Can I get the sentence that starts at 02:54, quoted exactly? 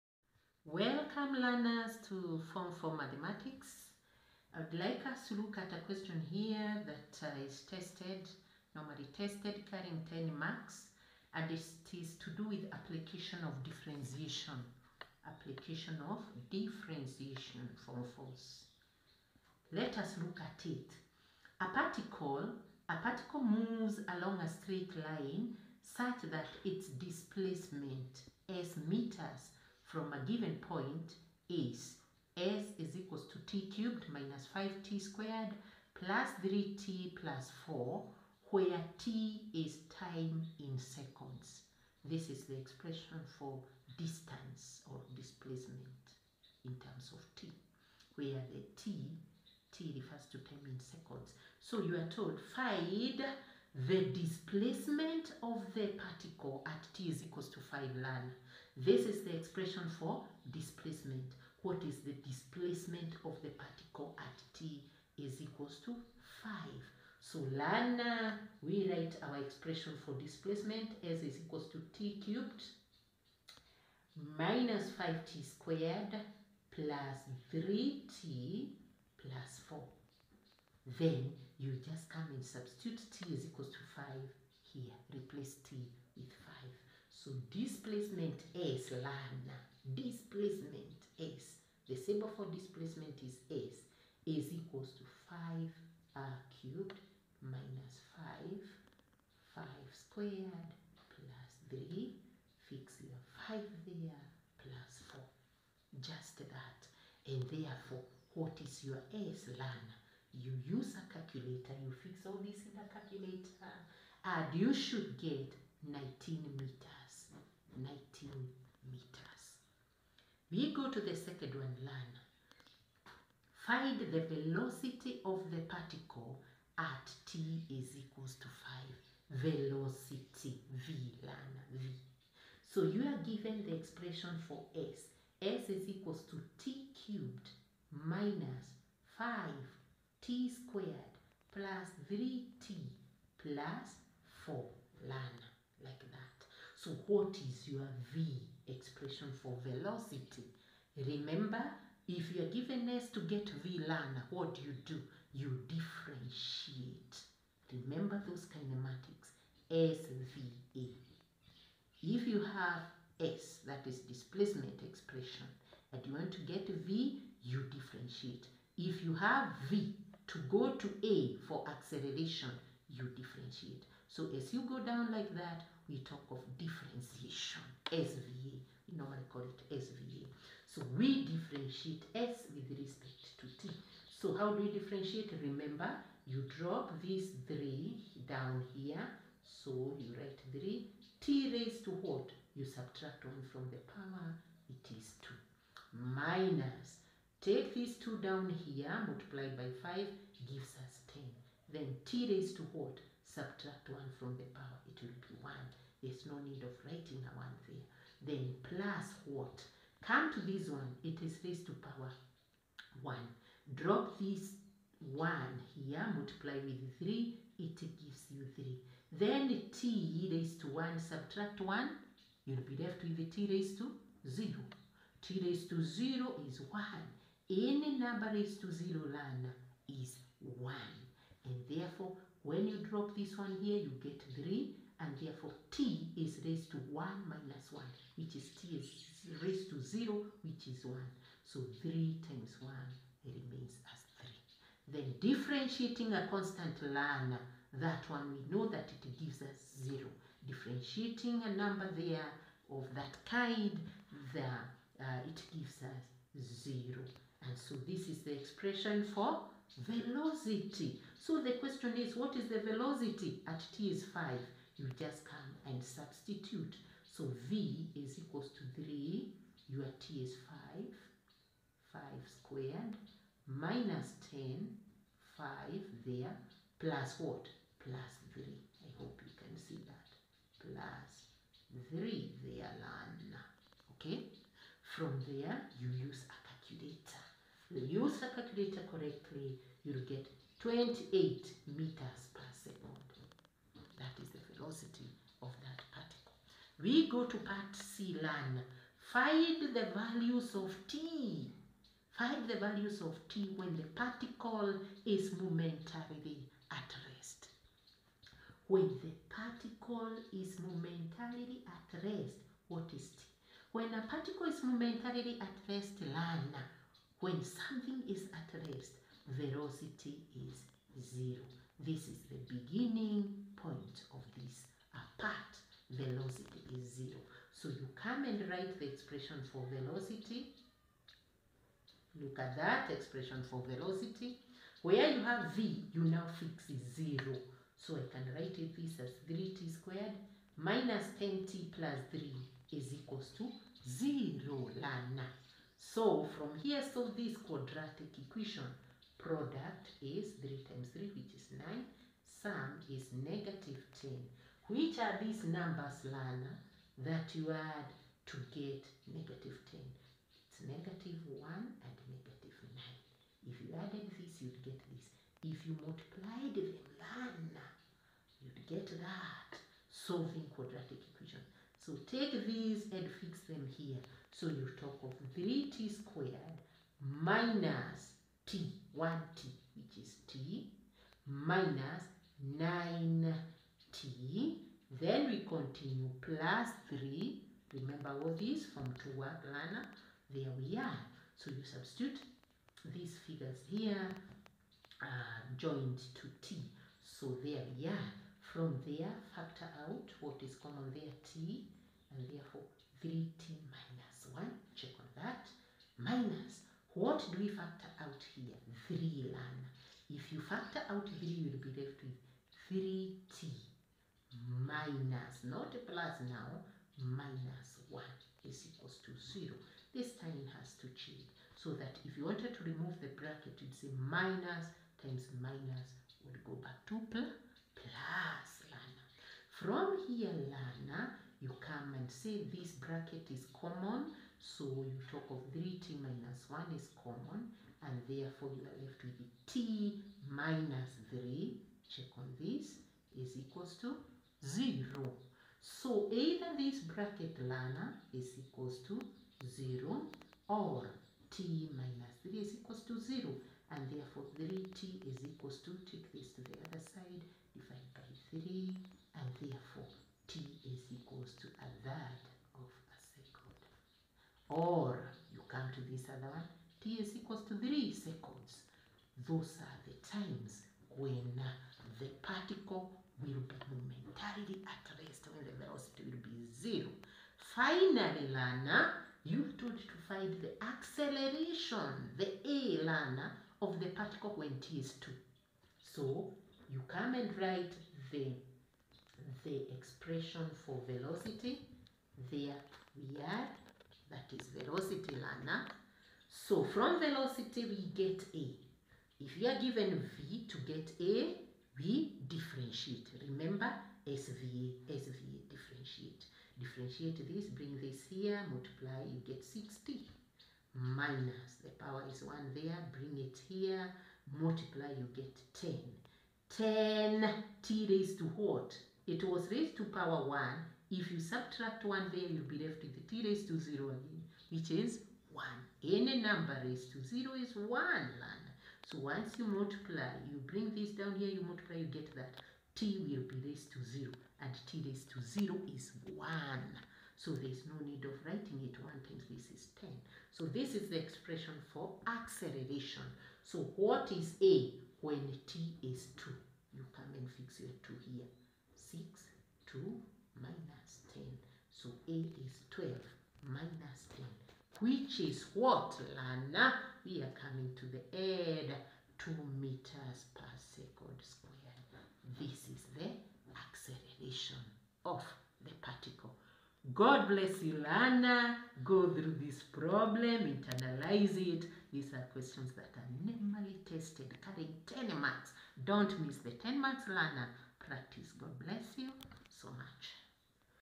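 So as you go down like that, we talk of differentiation, SVA.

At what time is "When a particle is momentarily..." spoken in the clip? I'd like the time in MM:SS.
05:13.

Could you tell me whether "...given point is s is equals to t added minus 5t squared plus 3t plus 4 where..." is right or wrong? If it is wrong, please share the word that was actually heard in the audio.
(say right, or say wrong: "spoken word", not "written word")
wrong: "cubed", not "added".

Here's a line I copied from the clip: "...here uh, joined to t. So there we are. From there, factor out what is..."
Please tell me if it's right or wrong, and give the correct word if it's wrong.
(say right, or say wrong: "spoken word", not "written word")
right.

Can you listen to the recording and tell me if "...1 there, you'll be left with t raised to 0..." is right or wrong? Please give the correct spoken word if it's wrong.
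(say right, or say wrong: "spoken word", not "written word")
right.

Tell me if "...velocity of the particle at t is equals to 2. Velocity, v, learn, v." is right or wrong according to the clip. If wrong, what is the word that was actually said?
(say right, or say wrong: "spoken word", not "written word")
wrong: "5", not "2".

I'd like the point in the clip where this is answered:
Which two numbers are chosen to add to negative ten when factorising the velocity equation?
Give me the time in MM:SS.
06:00.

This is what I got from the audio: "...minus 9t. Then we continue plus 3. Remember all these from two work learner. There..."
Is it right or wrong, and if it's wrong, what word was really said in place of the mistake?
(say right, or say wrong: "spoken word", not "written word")
right.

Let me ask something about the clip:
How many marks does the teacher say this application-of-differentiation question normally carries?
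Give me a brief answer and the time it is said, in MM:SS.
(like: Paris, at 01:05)
10, at 00:09.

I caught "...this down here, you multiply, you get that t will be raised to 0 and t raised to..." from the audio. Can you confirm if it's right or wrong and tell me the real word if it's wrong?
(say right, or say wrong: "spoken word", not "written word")
right.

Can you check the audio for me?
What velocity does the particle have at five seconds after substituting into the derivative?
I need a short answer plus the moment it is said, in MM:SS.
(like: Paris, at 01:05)
28 meters per second, at 04:50.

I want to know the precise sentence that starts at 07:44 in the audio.
Or you come to this other one, t is equals to 3 seconds.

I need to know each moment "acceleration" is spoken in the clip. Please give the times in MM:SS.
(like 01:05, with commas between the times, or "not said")
02:51, 08:00, 09:02, 09:23.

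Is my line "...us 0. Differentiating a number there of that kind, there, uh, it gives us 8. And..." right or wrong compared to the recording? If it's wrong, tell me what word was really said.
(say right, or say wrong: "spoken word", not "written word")
wrong: "0", not "8".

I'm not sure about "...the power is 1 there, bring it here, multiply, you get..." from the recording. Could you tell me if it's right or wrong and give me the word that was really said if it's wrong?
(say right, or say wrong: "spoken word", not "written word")
right.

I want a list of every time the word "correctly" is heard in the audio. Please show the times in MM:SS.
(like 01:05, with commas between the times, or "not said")
04:48.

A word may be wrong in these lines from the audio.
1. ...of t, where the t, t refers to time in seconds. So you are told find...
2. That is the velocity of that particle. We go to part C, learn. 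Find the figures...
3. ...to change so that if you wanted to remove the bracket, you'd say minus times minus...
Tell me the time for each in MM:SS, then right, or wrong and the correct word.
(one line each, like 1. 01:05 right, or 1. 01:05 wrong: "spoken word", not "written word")
1. 00:47 right
2. 04:53 wrong: "values", not "figures"
3. 07:00 right.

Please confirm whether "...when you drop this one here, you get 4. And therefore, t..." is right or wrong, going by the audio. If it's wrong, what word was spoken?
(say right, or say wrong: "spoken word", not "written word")
wrong: "3", not "4".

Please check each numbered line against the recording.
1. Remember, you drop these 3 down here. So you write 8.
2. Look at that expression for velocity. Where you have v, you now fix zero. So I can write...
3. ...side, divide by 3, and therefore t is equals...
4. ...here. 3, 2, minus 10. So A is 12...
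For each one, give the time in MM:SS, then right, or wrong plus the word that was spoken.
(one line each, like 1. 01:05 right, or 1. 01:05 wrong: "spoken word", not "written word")
1. 03:05 wrong: "3", not "8"
2. 05:32 right
3. 07:36 right
4. 09:08 wrong: "6", not "3".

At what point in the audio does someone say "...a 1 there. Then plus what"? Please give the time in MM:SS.
03:27.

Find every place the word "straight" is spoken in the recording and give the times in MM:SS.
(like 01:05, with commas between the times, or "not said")
00:24.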